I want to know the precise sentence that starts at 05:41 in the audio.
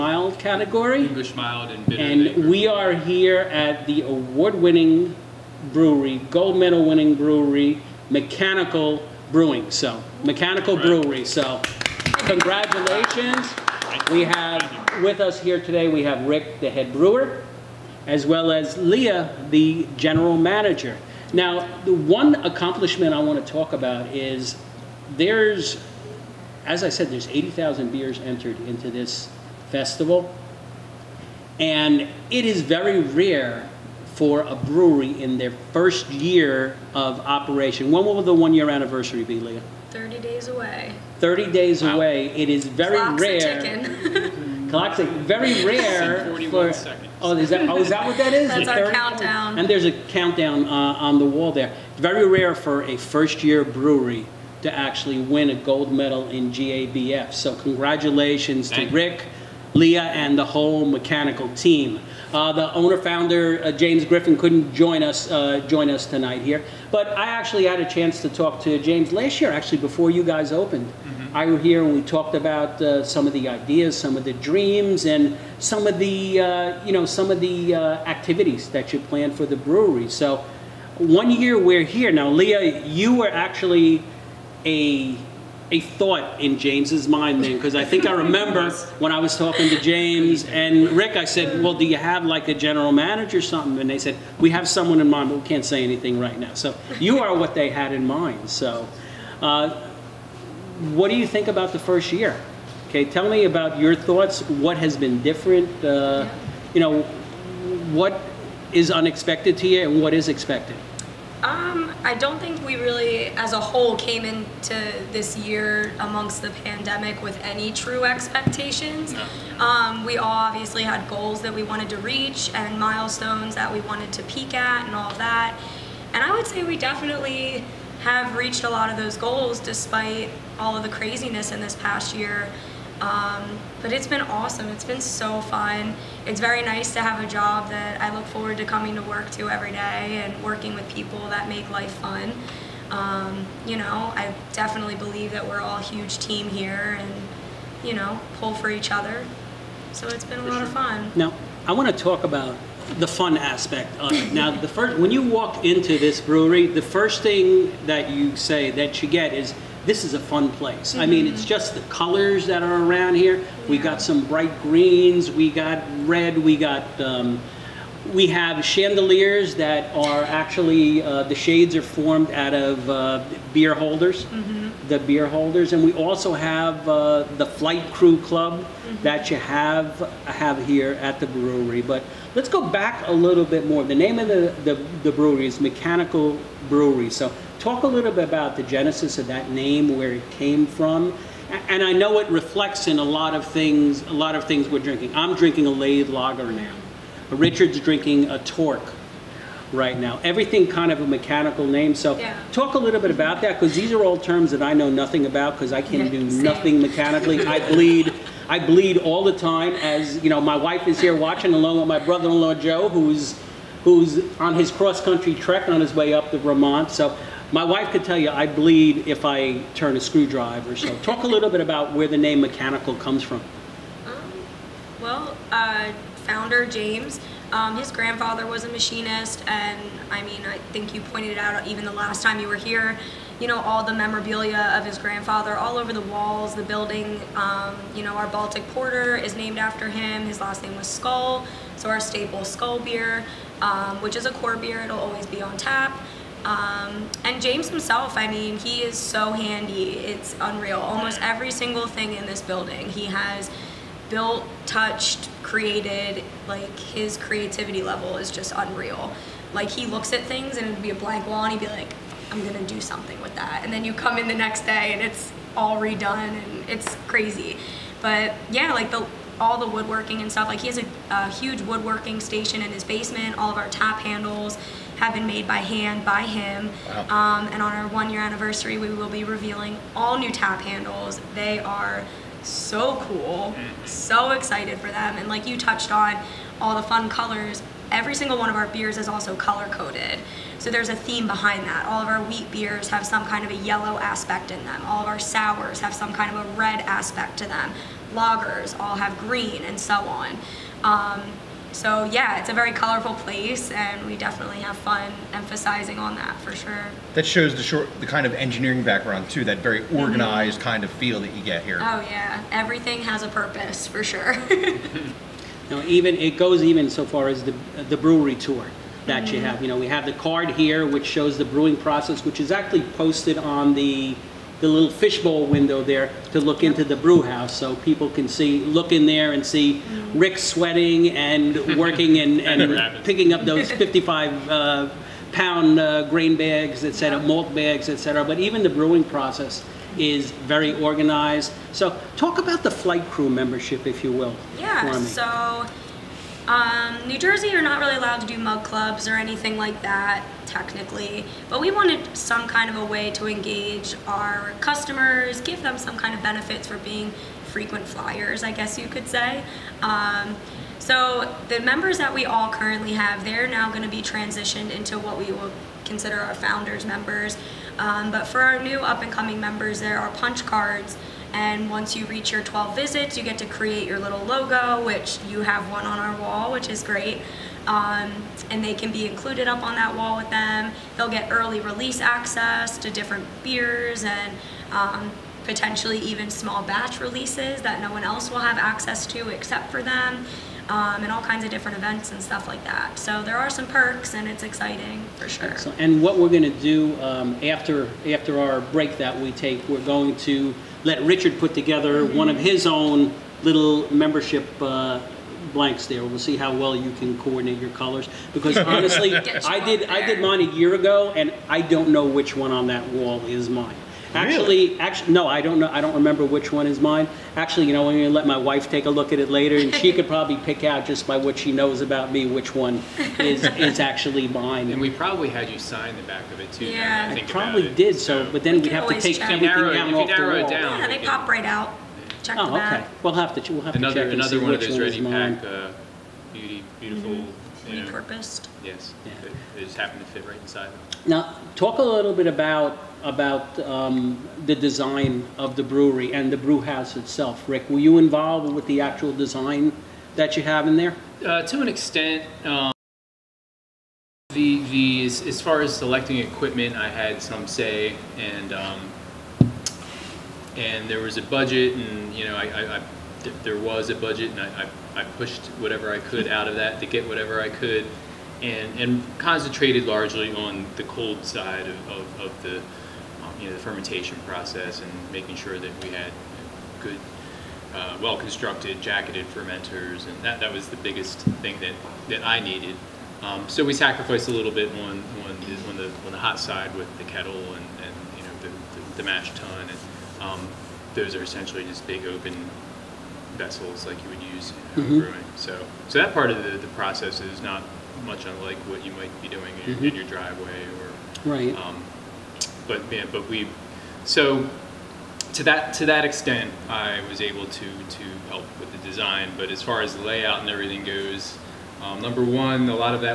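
So talk about the flight crew membership, if you will.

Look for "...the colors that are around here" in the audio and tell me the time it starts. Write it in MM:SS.
02:41.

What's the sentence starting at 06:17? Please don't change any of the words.
Um, and they can be included up on that wall with them.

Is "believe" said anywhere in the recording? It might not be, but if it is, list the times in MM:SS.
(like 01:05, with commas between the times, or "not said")
02:24.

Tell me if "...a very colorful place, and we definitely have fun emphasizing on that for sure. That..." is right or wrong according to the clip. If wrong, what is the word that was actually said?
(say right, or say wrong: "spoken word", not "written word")
right.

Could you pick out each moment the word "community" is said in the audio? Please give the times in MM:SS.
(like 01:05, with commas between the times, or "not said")
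not said.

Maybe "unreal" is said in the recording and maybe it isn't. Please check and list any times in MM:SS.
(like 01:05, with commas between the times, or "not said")
04:10, 04:18.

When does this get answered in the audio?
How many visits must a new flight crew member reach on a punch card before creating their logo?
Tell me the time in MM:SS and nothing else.
06:12.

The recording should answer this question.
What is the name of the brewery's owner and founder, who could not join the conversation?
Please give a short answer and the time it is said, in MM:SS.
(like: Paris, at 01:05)
James Griffin, at 01:03.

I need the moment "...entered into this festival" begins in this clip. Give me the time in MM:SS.
00:28.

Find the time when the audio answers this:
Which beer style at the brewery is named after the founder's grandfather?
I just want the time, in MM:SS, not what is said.
03:58.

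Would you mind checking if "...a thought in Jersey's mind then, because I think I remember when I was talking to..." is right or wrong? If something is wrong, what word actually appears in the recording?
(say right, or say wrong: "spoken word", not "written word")
wrong: "James", not "Jersey".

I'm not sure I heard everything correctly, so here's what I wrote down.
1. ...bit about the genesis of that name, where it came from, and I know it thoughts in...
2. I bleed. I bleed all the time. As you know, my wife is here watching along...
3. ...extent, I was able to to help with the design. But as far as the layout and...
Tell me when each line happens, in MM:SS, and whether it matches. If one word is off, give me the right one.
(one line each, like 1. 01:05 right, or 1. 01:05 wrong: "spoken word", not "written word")
1. 03:08 wrong: "reflects", not "thoughts"
2. 03:27 right
3. 08:26 right.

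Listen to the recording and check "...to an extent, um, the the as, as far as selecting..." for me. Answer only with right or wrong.
right.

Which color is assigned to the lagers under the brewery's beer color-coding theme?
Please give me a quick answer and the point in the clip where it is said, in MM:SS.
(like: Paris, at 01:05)
Green, at 04:59.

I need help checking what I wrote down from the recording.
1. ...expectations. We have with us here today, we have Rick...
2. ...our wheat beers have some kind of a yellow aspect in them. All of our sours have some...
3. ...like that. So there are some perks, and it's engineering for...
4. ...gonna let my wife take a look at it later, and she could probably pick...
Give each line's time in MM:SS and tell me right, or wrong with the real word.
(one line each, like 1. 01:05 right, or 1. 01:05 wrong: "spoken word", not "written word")
1. 00:12 wrong: "congratulations", not "expectations"
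2. 04:52 right
3. 06:32 wrong: "exciting", not "engineering"
4. 06:57 right.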